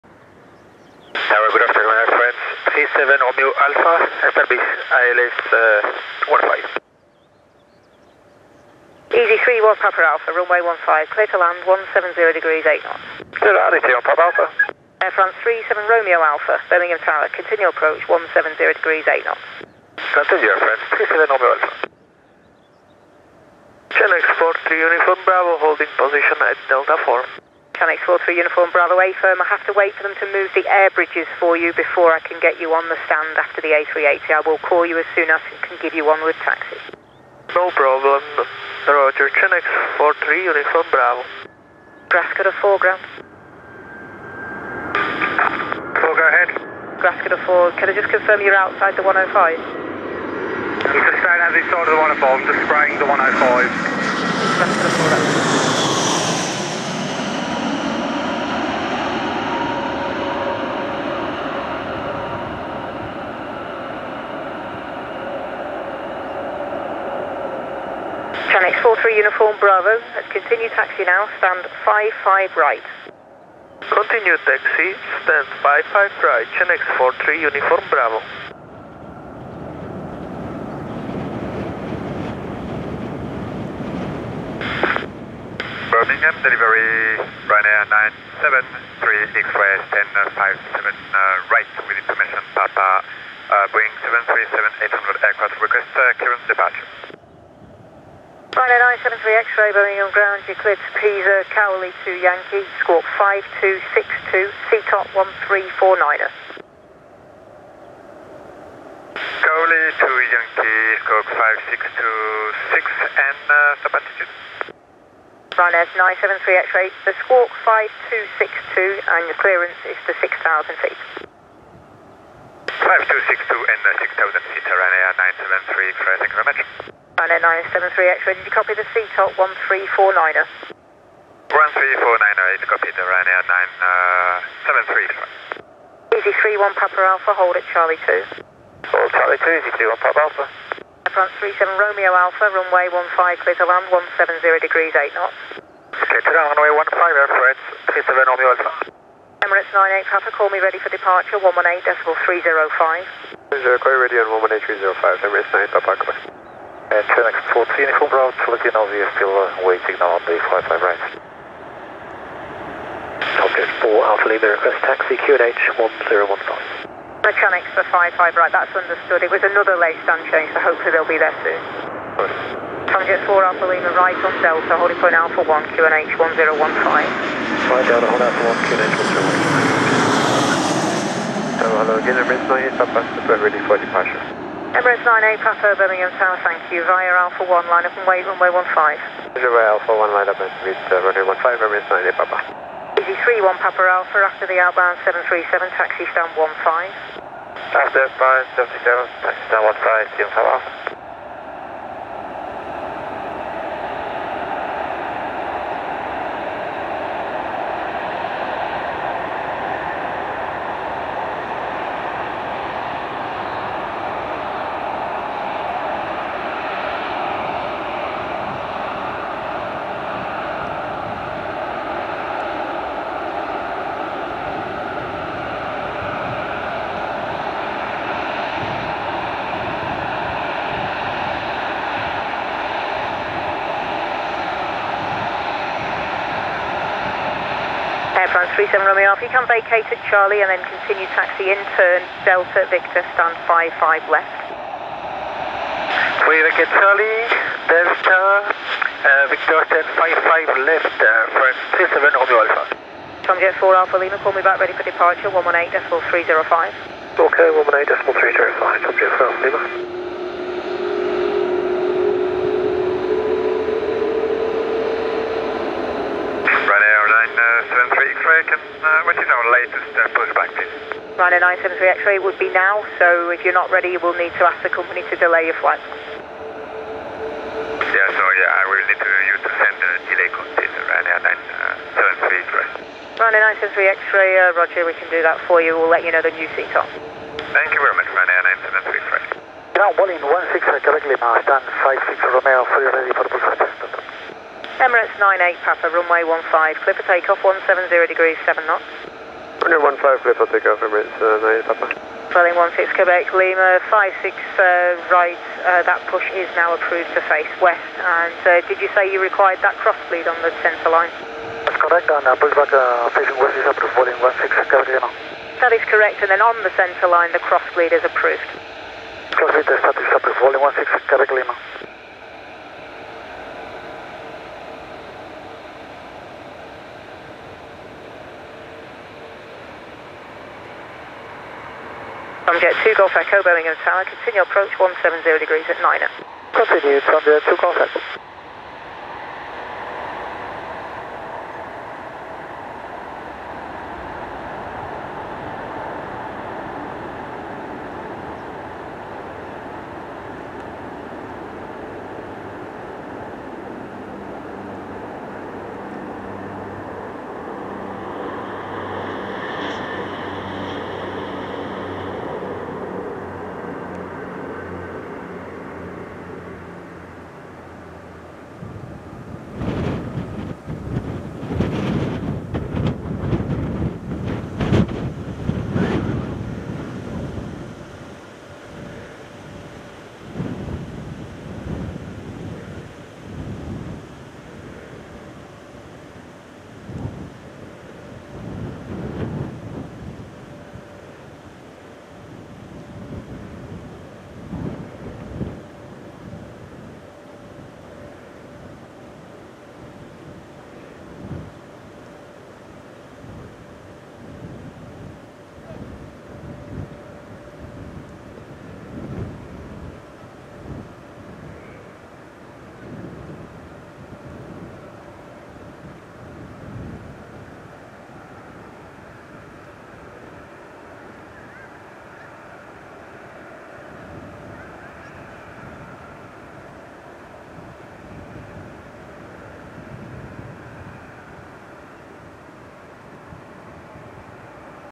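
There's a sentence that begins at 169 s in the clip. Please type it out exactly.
It was another late stand change, so hopefully they'll be there soon.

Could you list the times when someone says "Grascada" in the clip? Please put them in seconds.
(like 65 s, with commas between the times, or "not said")
42 s, 47 s.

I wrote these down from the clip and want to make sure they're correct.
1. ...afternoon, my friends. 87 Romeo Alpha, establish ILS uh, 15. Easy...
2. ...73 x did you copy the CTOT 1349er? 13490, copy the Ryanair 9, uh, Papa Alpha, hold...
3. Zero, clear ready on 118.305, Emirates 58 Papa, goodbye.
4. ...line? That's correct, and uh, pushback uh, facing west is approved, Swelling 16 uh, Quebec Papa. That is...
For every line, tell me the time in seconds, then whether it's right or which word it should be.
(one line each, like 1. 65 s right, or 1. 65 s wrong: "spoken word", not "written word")
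1. 1 s wrong: "37", not "87"
2. 127 s right
3. 153 s wrong: "98", not "58"
4. 310 s wrong: "Lima", not "Papa".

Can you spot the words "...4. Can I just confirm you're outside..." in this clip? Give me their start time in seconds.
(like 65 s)
47 s.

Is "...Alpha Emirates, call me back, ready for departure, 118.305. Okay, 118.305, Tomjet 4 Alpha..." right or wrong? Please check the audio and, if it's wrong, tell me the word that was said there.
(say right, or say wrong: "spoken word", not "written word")
wrong: "Lima", not "Emirates".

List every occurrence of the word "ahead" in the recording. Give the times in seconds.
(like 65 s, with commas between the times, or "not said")
46 s.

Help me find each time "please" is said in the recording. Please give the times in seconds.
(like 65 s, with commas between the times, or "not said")
270 s, 282 s.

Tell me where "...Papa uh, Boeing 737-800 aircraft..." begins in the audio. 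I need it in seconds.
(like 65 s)
92 s.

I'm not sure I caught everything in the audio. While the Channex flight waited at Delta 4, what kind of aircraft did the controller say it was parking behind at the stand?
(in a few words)
A380.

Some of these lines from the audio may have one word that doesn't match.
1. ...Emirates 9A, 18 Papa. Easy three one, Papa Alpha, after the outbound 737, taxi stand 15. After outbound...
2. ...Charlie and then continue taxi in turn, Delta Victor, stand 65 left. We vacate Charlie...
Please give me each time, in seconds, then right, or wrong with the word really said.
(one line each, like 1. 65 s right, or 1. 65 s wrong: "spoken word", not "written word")
1. 191 s wrong: "98", not "18"
2. 240 s wrong: "55", not "65".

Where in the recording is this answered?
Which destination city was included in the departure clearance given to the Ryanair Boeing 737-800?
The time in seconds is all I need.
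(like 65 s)
100 s.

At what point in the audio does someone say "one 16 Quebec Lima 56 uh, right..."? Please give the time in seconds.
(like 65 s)
302 s.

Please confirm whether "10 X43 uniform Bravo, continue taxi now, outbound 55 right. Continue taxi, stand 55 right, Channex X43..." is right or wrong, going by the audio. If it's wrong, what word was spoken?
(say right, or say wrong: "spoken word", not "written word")
wrong: "stand", not "outbound".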